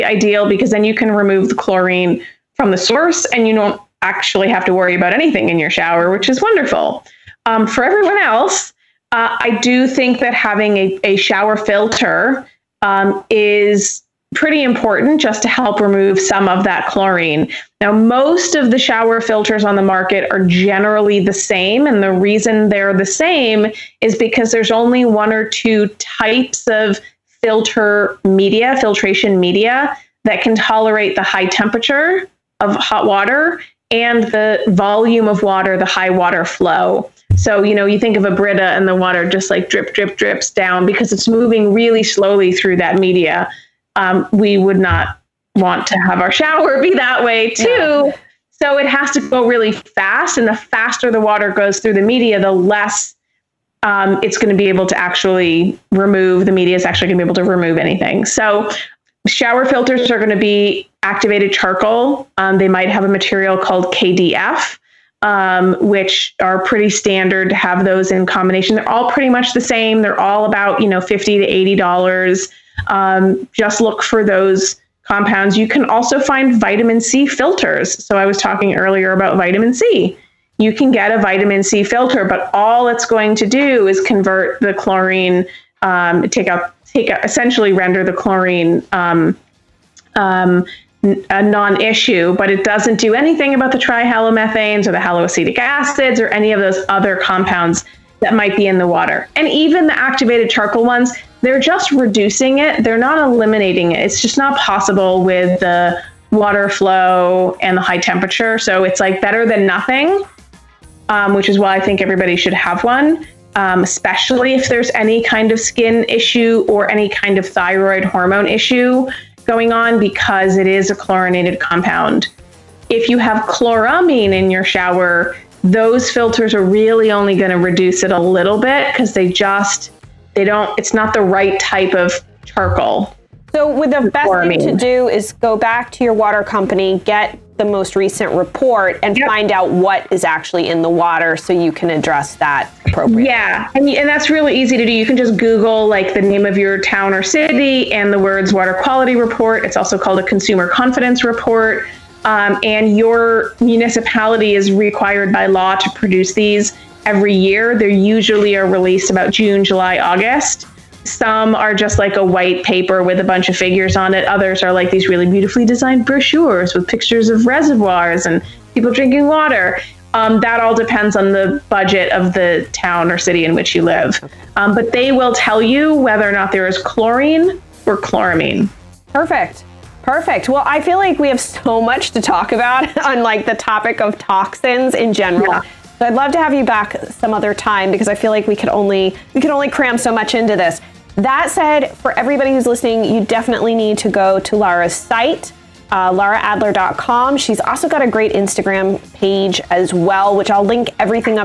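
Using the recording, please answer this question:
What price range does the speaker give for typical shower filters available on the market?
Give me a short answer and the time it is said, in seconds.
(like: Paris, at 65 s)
$50 to $80, at 70 s.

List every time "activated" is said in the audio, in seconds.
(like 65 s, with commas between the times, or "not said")
61 s, 99 s.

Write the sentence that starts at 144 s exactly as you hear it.
You can just Google like the name of your town or city and the words water quality report.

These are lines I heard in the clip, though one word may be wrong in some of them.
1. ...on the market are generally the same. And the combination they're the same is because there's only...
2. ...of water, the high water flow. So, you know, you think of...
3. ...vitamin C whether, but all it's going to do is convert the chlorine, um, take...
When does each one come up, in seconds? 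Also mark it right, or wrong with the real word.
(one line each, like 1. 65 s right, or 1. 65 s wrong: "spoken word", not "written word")
1. 19 s wrong: "reason", not "combination"
2. 35 s right
3. 81 s wrong: "filter", not "whether".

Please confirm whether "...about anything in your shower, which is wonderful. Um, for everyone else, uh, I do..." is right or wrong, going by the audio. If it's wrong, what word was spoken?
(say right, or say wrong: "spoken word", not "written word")
right.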